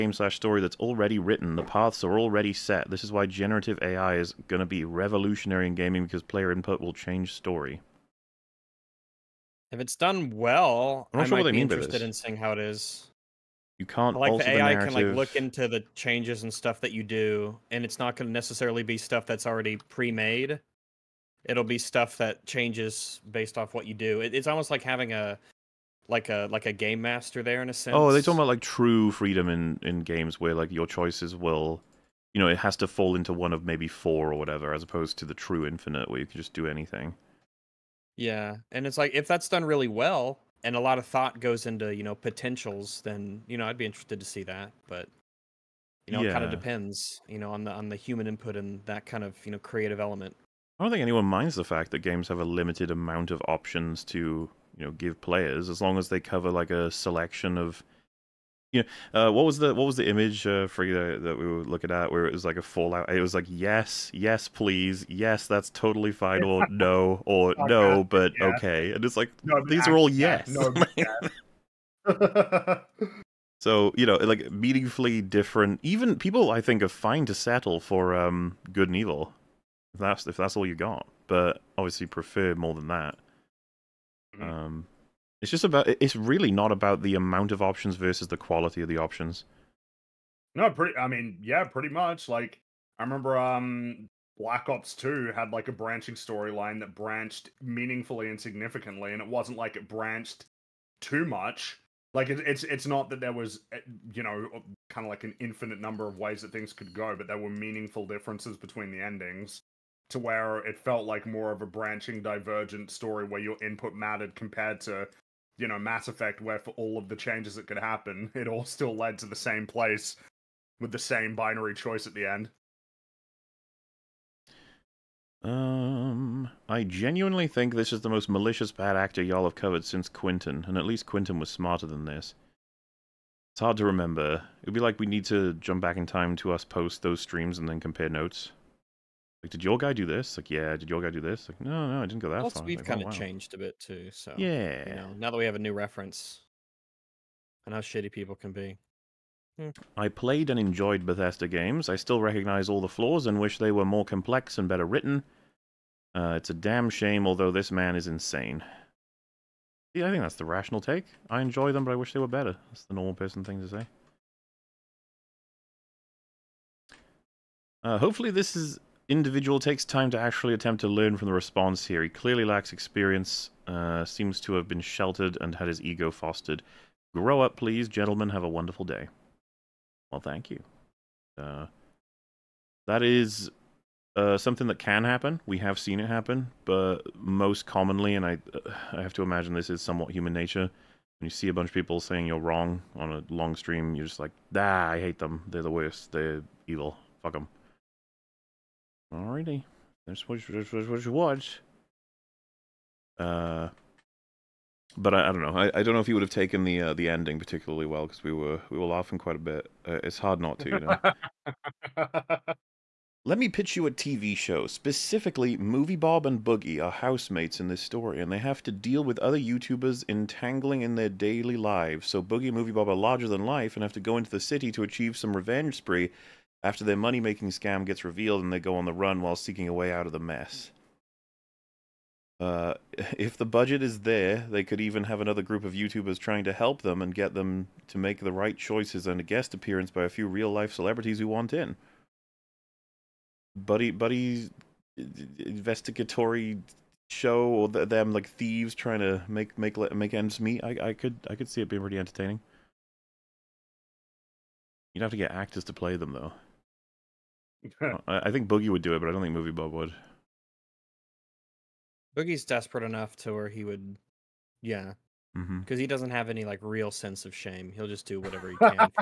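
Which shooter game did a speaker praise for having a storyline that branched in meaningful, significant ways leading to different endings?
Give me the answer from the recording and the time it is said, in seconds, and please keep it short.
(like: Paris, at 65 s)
Black Ops Two, at 94 s.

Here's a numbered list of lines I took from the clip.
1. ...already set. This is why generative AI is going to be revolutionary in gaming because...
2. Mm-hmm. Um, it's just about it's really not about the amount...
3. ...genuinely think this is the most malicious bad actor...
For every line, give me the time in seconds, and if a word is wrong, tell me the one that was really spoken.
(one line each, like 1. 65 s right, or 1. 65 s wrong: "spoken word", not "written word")
1. 2 s right
2. 84 s right
3. 126 s right.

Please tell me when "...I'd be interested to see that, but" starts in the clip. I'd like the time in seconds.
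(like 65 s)
43 s.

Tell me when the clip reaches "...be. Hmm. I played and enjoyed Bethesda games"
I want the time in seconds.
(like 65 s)
148 s.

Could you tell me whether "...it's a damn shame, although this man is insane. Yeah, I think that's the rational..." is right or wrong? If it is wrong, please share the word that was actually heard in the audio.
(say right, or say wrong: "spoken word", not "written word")
right.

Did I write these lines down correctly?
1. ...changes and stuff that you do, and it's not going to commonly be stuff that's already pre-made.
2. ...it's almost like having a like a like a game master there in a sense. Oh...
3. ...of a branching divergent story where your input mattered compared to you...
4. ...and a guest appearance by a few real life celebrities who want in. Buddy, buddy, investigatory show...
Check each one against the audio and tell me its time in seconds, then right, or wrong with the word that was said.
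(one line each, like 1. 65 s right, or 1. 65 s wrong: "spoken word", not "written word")
1. 15 s wrong: "necessarily", not "commonly"
2. 24 s right
3. 111 s right
4. 239 s right.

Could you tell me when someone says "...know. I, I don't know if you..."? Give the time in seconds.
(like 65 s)
205 s.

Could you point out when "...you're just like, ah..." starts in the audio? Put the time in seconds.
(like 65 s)
193 s.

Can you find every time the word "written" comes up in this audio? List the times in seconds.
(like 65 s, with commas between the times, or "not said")
1 s, 154 s.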